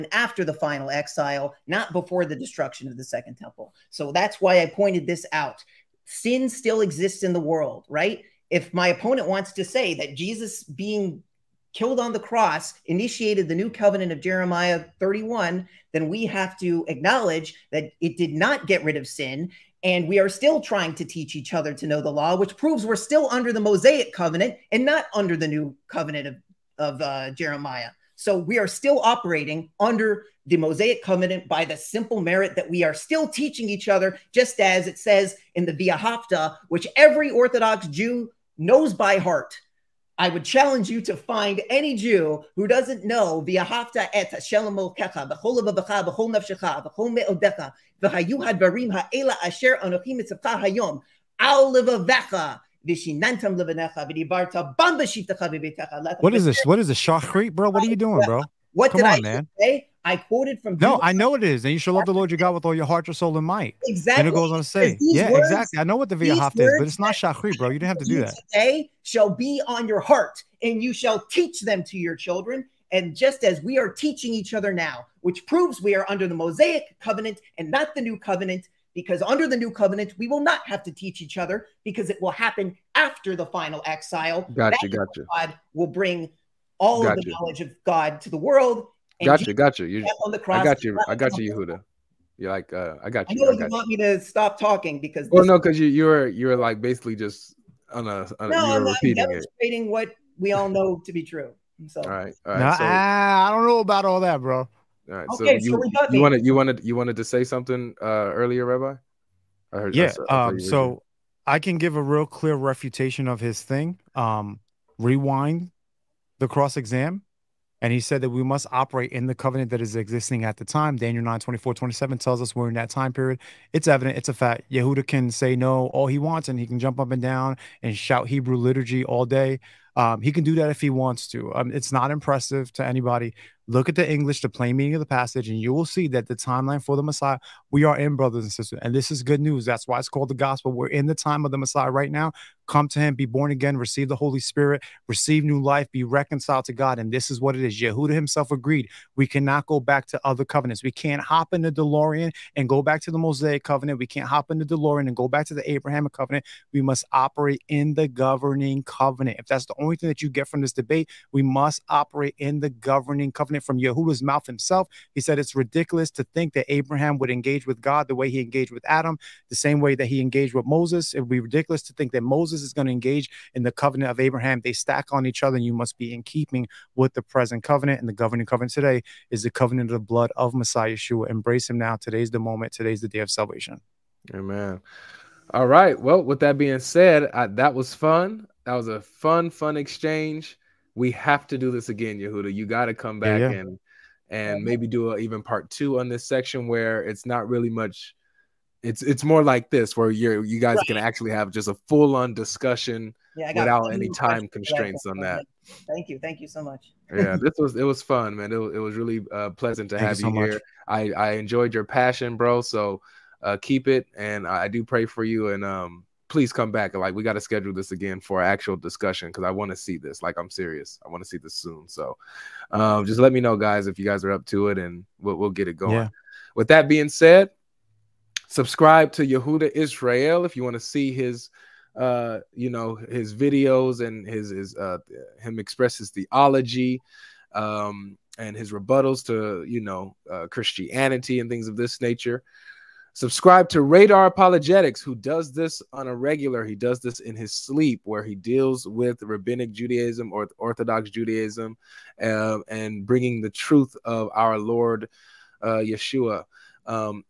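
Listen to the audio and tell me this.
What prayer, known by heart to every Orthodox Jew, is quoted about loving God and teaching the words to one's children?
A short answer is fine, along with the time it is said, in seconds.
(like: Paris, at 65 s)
V'ahavta, at 35 s.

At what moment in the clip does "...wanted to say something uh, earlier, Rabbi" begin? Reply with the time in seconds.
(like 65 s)
106 s.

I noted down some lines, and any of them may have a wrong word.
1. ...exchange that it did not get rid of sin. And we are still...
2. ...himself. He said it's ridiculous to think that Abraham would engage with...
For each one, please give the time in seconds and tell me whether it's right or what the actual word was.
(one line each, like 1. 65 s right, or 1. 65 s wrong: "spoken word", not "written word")
1. 16 s wrong: "acknowledge", not "exchange"
2. 164 s right.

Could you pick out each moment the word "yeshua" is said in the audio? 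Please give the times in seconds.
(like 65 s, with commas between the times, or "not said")
180 s, 255 s.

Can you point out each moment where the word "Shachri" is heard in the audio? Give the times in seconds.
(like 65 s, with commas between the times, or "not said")
67 s.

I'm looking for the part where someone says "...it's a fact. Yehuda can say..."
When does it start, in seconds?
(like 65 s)
124 s.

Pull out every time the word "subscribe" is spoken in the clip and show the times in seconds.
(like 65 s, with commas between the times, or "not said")
228 s, 243 s.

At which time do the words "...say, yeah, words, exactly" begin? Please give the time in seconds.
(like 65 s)
64 s.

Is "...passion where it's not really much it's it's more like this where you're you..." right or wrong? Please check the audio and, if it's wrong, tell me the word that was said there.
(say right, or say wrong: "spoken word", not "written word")
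wrong: "section", not "passion".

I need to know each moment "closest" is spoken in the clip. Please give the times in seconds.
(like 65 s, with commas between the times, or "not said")
not said.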